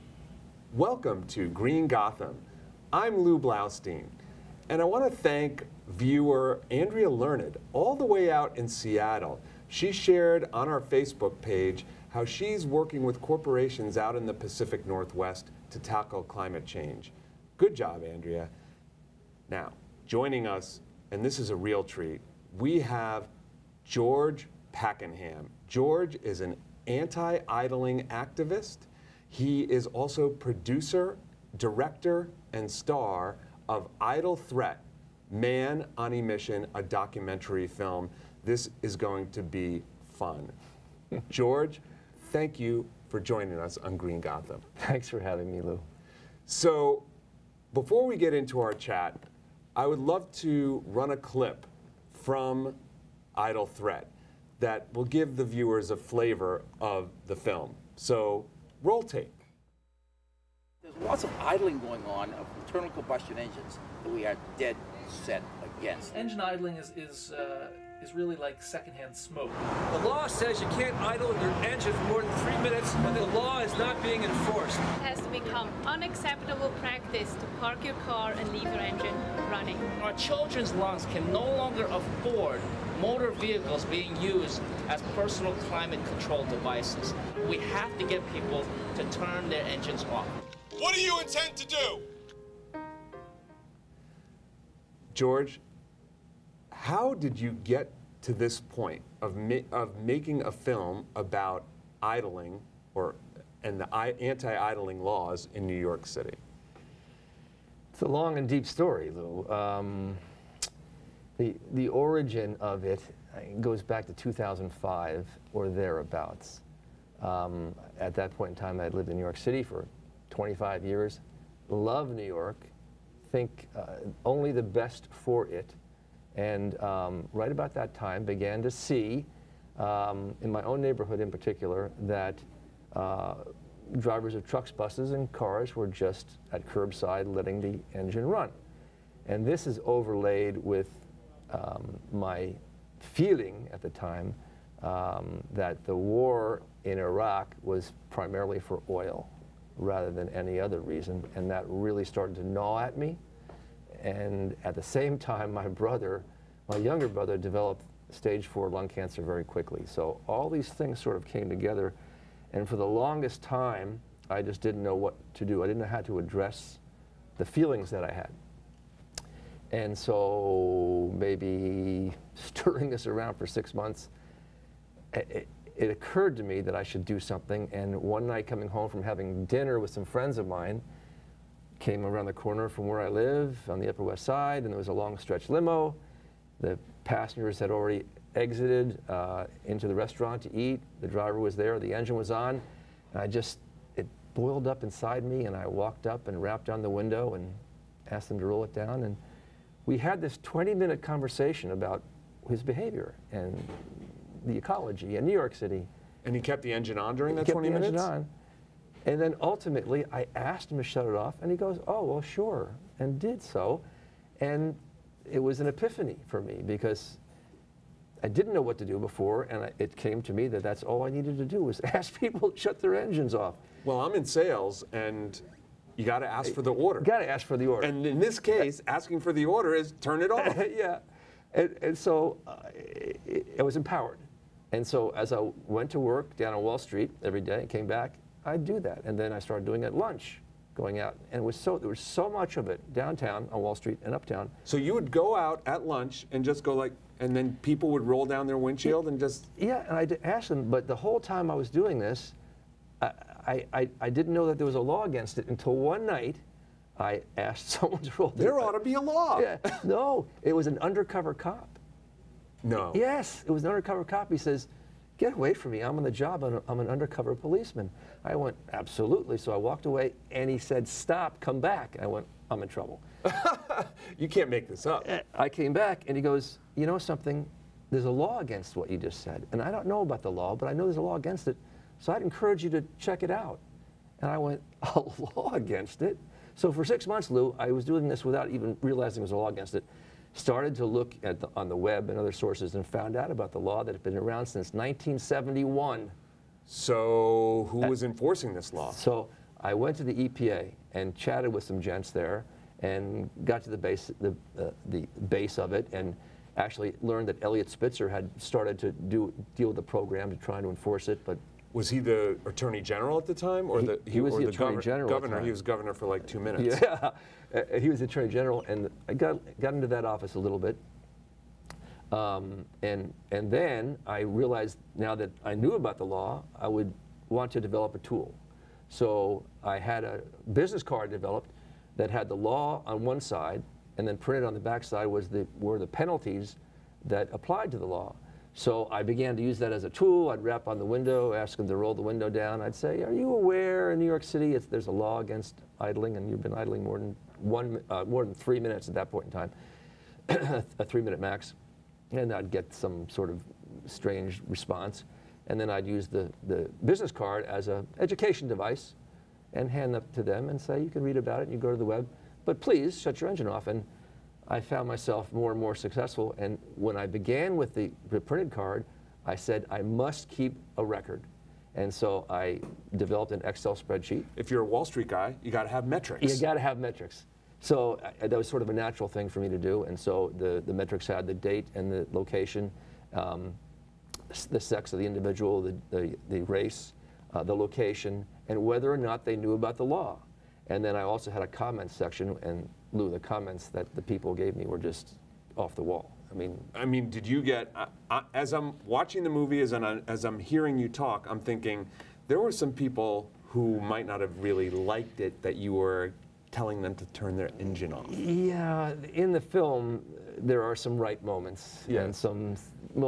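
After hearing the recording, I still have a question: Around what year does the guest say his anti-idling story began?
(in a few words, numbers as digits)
2005.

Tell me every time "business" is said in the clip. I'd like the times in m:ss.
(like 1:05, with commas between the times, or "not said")
5:30, 5:56.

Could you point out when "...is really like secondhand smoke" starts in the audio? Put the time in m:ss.
1:08.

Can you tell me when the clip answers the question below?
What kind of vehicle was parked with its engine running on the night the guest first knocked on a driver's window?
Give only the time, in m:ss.
3:04.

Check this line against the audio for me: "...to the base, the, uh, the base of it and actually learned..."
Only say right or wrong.
right.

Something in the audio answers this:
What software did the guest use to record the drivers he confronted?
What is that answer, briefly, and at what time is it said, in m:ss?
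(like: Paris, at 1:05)
Excel spreadsheet, at 6:13.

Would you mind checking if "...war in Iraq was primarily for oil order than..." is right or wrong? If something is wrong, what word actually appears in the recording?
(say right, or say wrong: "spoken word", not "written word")
wrong: "rather", not "order".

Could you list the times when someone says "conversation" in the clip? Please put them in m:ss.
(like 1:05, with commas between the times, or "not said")
3:21.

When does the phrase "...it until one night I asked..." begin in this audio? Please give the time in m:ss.
4:15.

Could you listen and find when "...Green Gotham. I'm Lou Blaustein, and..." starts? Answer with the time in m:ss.
0:01.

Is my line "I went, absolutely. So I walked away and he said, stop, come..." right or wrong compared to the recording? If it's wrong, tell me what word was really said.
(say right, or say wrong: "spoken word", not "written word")
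right.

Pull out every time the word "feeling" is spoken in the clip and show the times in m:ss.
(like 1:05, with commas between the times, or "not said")
2:22, 2:47.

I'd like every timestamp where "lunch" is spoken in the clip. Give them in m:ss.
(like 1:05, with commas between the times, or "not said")
3:59, 4:05.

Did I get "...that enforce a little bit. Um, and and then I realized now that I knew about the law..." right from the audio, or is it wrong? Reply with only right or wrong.
wrong.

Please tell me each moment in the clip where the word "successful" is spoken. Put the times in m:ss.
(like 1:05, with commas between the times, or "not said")
6:05.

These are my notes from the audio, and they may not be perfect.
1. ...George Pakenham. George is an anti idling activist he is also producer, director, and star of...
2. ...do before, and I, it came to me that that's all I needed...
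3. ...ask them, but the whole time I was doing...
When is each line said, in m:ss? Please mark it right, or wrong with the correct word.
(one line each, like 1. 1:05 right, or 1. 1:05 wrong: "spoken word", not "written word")
1. 0:23 right
2. 3:38 right
3. 4:10 right.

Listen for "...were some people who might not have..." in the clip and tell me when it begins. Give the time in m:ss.
6:42.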